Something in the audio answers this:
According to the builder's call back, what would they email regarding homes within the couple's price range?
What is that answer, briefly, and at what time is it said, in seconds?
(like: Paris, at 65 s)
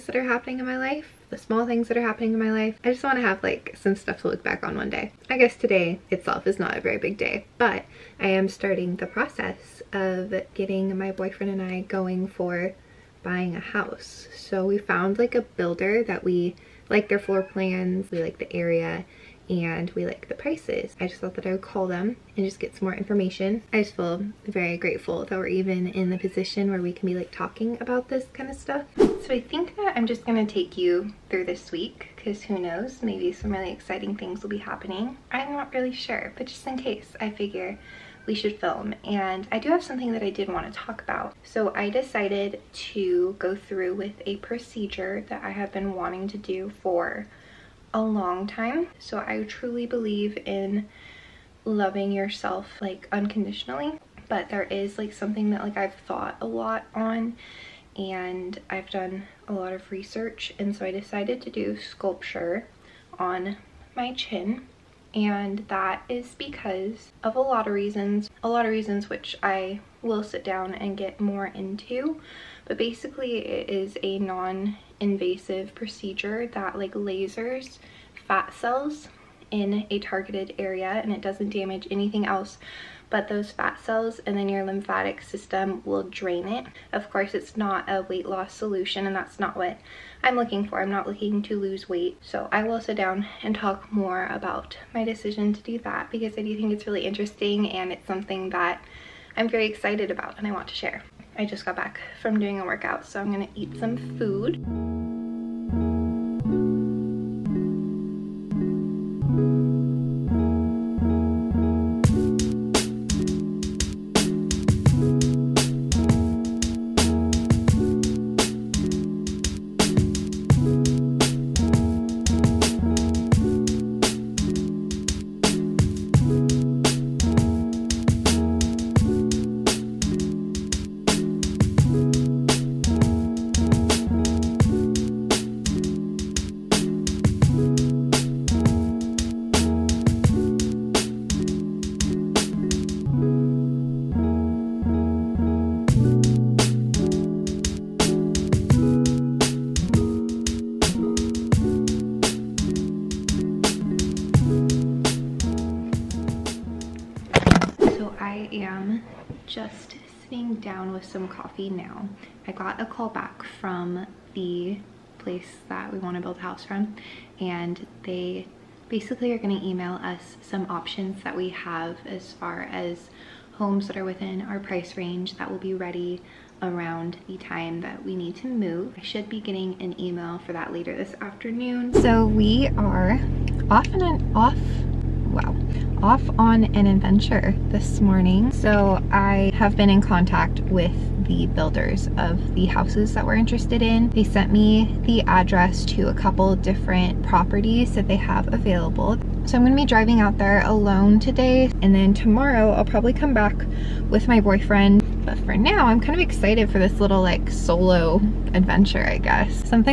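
some options, at 170 s.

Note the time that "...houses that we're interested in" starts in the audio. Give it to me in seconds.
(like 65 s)
192 s.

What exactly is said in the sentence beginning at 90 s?
I'm not looking to lose weight.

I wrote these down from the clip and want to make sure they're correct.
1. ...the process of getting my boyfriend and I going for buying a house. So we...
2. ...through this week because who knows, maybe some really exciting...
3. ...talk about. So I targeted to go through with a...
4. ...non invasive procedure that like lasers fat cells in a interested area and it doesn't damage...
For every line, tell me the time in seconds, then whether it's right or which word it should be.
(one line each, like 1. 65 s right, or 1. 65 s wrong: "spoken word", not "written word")
1. 8 s right
2. 31 s right
3. 40 s wrong: "decided", not "targeted"
4. 74 s wrong: "targeted", not "interested".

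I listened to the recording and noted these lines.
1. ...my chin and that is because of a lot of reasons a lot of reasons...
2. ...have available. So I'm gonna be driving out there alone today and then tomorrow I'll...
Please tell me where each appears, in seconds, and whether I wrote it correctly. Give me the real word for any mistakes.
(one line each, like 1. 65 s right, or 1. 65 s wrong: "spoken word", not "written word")
1. 63 s right
2. 198 s right.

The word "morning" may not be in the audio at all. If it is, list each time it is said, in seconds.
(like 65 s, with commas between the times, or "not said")
188 s.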